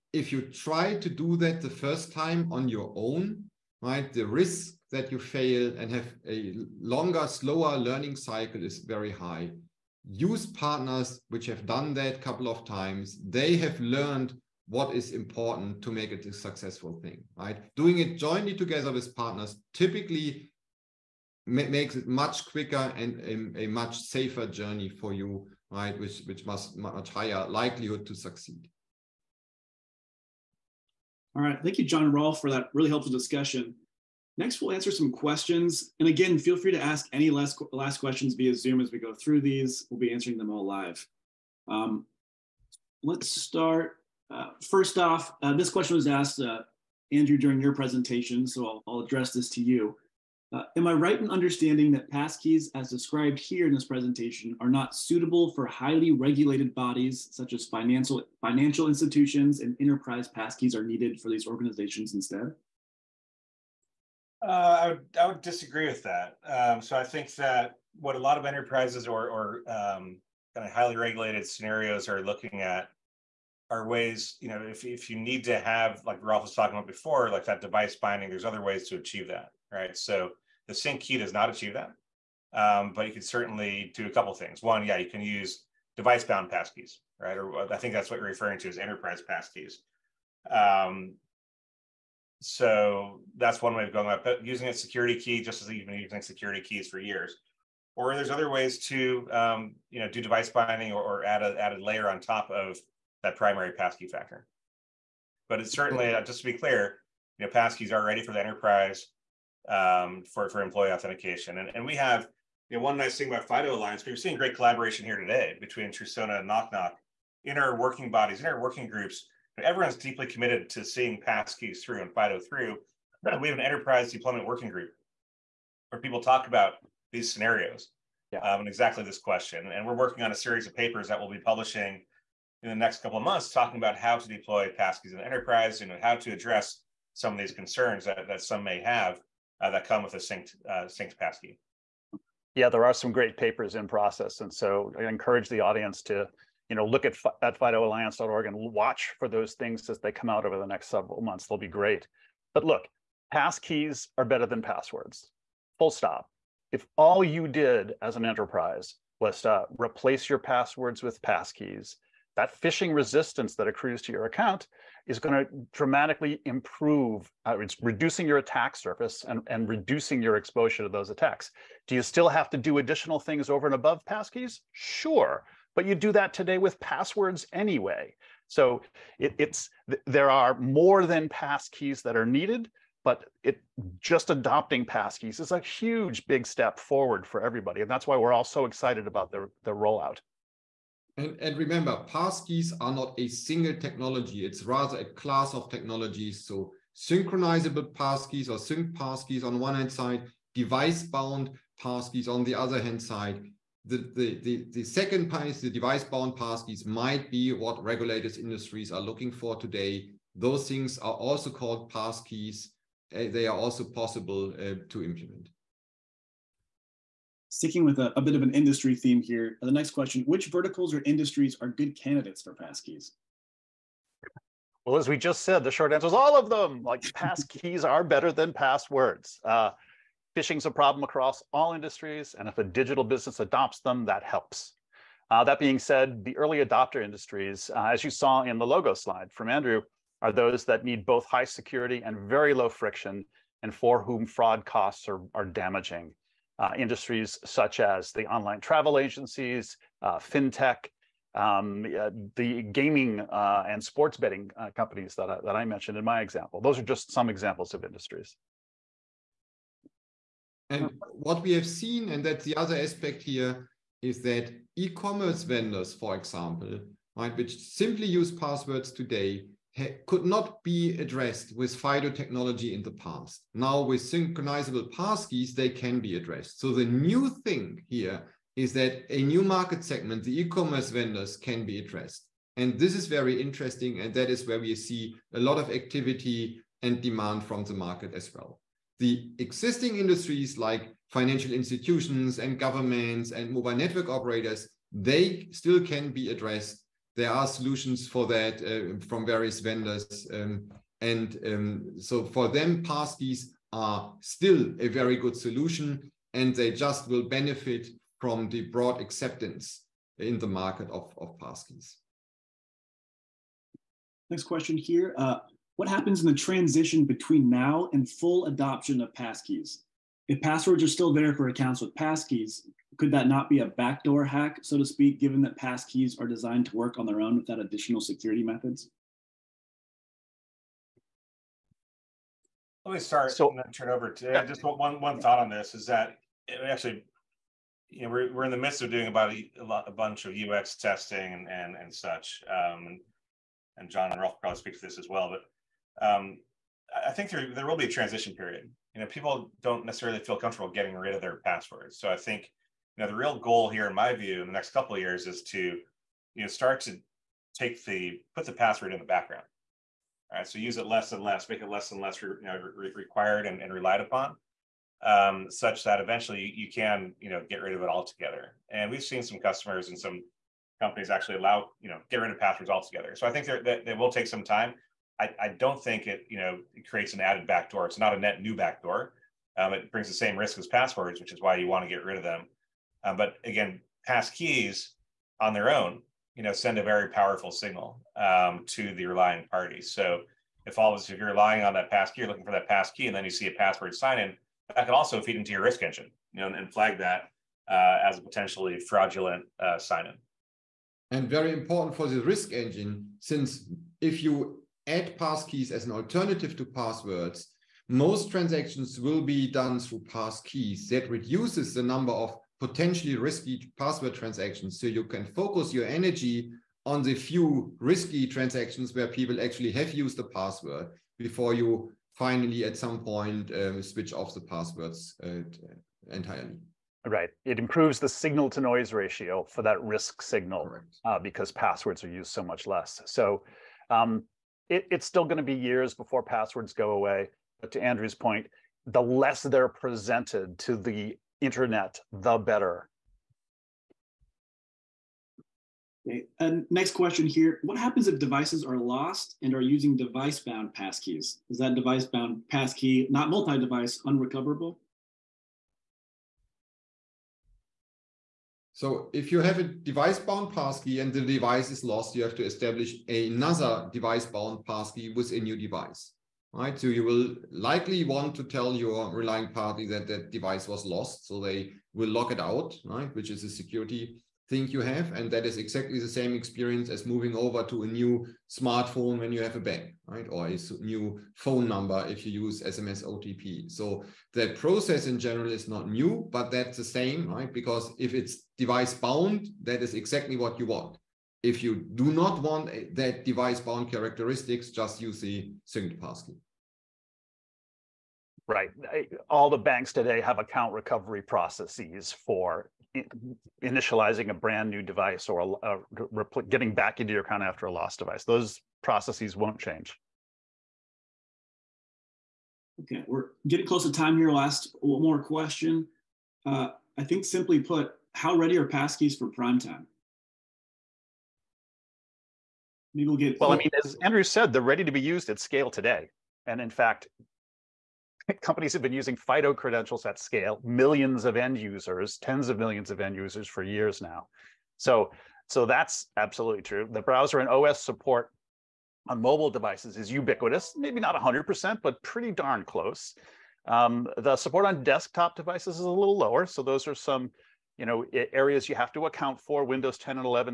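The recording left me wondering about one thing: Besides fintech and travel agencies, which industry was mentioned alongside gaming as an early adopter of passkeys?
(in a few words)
Sports betting.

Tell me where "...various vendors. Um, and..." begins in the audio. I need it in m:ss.
4:59.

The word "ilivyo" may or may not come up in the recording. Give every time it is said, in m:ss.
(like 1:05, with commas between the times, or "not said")
not said.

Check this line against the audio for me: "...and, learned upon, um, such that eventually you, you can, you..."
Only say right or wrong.
wrong.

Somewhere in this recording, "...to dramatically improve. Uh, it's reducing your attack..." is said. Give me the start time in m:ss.
2:45.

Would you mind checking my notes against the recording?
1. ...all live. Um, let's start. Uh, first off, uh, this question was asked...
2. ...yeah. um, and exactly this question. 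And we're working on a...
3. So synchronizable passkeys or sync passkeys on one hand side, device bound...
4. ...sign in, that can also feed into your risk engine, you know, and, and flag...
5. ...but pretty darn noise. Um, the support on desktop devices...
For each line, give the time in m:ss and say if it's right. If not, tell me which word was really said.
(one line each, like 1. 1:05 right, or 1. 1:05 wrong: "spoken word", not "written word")
1. 0:40 right
2. 2:08 right
3. 3:16 right
4. 6:33 right
5. 9:01 wrong: "close", not "noise".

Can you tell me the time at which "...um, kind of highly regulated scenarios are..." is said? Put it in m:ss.
1:09.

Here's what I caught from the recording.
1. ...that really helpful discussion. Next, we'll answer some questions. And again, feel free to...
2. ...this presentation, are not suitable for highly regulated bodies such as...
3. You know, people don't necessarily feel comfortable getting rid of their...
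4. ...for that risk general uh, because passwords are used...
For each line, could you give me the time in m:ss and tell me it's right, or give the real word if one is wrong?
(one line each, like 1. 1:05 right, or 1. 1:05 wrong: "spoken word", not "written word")
1. 0:32 right
2. 0:53 right
3. 5:48 right
4. 7:09 wrong: "signal", not "general".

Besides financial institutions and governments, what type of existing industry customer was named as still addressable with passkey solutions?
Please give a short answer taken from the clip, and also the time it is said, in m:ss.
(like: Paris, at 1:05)
Mobile network operators, at 4:53.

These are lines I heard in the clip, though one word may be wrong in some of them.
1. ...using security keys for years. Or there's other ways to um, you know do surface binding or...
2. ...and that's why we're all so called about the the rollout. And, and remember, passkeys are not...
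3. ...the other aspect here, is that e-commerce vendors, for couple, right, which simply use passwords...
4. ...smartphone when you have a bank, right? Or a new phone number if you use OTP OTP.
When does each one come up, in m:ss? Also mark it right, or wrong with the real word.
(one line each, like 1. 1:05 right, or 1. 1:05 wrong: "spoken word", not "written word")
1. 1:35 wrong: "device", not "surface"
2. 3:07 wrong: "excited", not "called"
3. 4:22 wrong: "example", not "couple"
4. 7:58 wrong: "SMS", not "OTP".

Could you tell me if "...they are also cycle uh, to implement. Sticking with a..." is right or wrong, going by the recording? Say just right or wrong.
wrong.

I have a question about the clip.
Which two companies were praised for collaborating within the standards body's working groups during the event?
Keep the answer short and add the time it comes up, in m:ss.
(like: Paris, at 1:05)
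Trusona and Nok Nok, at 1:55.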